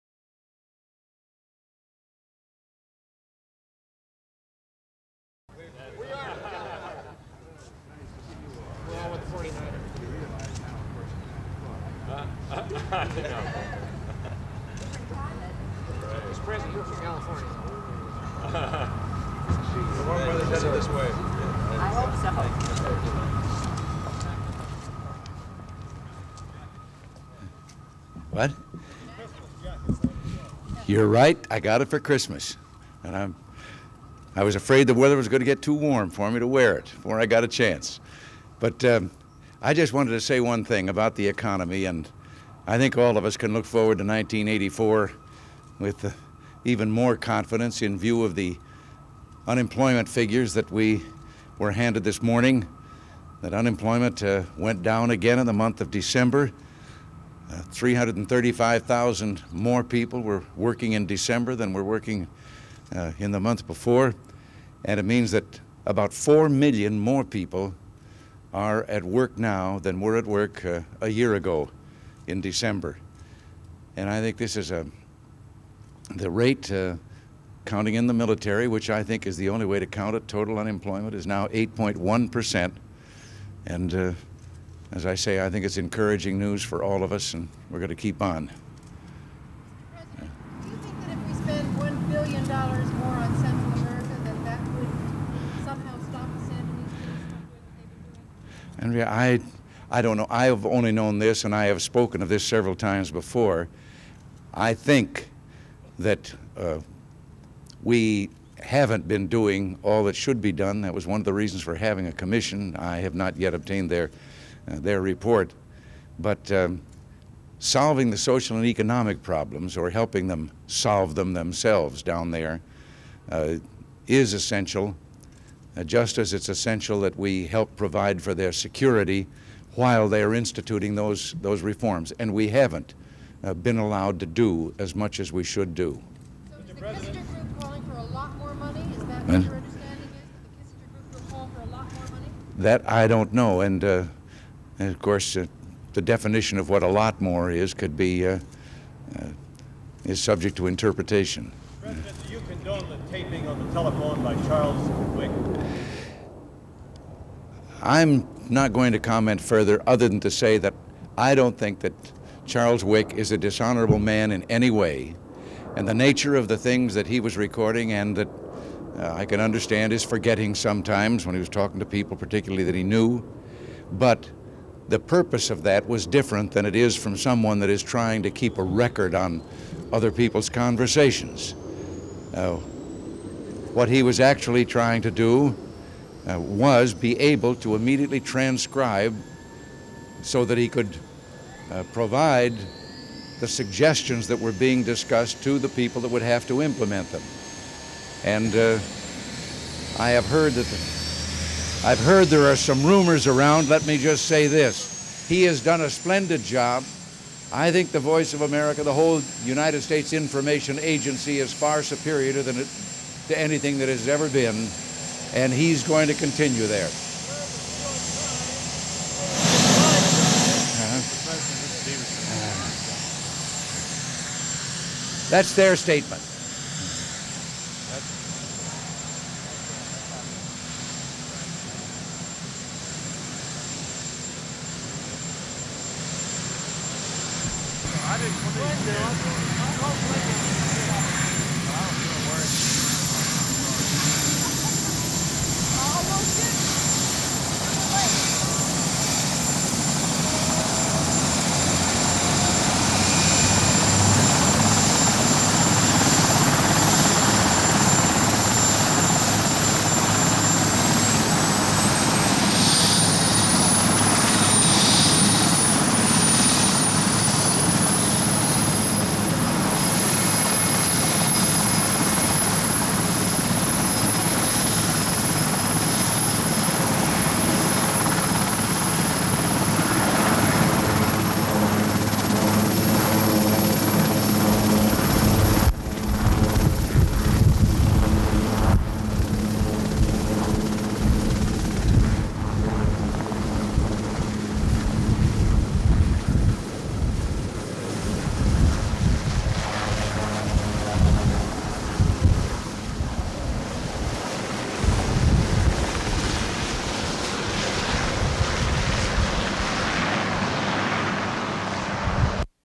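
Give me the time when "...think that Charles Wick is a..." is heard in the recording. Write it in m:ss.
2:41.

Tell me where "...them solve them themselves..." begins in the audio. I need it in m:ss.
2:00.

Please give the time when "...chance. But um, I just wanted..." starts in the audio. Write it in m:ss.
0:37.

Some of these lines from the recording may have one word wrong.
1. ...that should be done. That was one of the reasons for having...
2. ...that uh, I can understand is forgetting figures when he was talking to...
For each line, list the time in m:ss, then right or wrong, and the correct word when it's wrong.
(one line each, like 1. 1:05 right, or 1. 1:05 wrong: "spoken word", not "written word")
1. 1:50 right
2. 2:48 wrong: "sometimes", not "figures".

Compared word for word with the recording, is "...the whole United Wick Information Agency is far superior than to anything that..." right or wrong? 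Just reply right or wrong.
wrong.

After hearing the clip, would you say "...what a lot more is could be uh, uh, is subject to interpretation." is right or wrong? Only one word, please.
right.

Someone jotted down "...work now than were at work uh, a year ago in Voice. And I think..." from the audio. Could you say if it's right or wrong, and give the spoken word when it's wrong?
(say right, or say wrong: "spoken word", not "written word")
wrong: "December", not "Voice".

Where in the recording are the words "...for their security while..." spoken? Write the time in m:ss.
2:08.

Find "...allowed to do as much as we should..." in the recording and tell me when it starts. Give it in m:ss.
2:13.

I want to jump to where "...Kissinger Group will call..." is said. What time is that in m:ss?
2:21.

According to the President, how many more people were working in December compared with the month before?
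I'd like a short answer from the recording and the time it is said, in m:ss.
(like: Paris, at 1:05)
335,000, at 0:57.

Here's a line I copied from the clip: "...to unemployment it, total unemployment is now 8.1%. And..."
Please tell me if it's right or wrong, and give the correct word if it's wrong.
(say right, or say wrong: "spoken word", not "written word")
wrong: "count", not "unemployment".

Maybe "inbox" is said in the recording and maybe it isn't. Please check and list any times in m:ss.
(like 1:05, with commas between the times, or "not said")
not said.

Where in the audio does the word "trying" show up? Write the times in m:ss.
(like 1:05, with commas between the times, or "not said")
2:57, 3:04.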